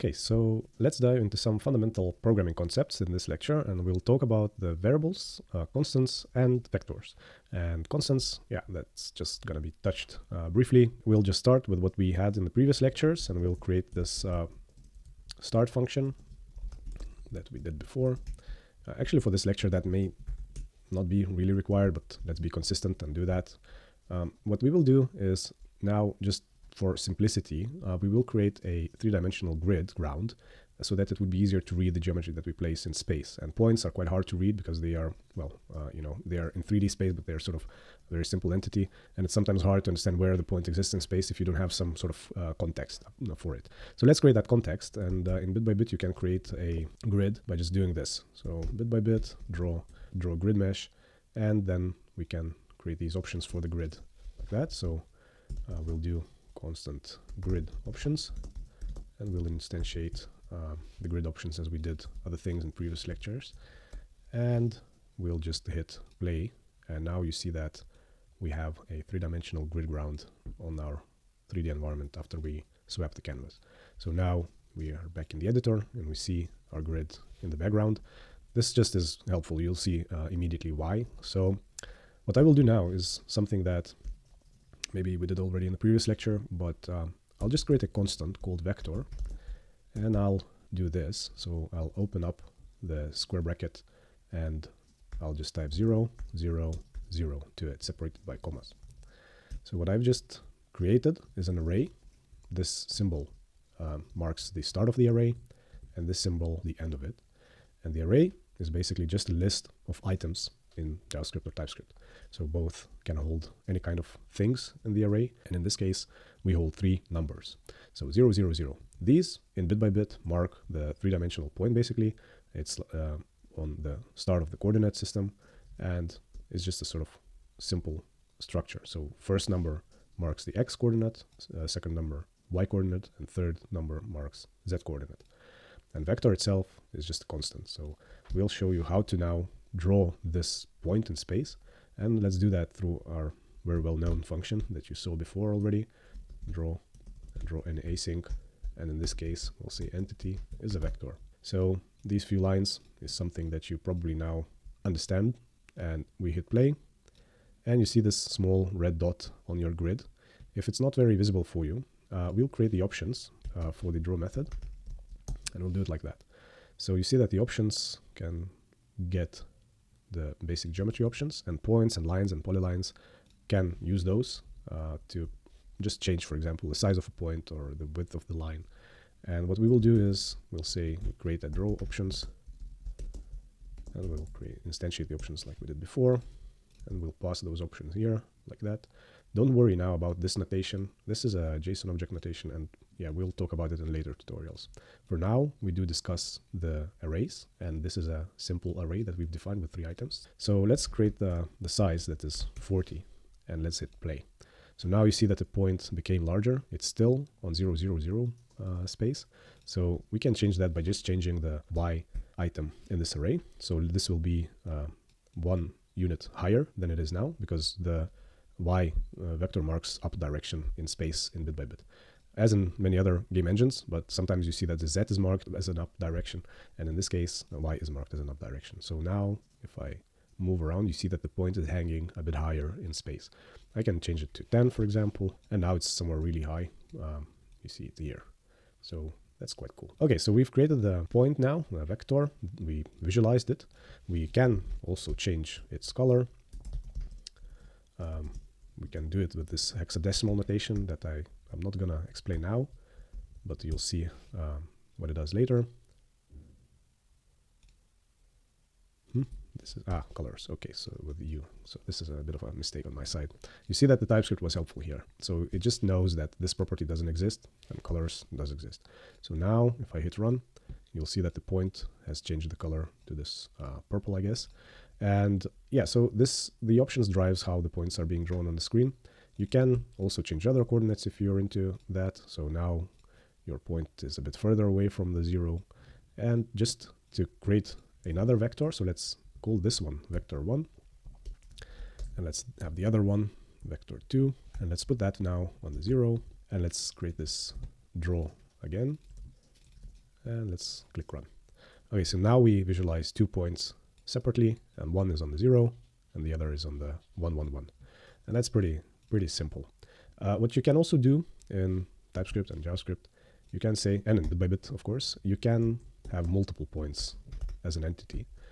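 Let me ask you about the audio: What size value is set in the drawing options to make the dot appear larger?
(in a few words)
40.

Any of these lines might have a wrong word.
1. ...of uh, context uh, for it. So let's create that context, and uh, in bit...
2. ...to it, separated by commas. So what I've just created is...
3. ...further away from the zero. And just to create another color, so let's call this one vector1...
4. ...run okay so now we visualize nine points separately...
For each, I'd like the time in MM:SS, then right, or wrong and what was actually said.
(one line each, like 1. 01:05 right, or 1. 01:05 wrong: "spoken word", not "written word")
1. 00:42 right
2. 01:37 right
3. 04:44 wrong: "vector", not "color"
4. 05:01 wrong: "two", not "nine".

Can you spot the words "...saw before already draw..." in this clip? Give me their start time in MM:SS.
02:24.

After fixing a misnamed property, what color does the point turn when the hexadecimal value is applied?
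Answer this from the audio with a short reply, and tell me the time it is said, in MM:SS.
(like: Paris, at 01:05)
purple, at 04:33.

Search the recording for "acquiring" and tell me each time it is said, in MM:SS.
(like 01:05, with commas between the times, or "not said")
not said.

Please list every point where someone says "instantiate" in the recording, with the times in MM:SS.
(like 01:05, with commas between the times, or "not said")
00:59, 03:04.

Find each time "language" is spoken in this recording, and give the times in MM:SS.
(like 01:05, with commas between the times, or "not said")
not said.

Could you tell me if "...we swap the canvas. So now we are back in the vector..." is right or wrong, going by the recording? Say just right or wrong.
wrong.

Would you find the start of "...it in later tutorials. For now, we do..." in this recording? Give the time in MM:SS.
03:13.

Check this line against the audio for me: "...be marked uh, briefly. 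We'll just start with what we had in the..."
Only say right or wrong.
wrong.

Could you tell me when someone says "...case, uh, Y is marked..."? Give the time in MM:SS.
03:47.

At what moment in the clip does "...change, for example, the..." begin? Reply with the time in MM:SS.
02:56.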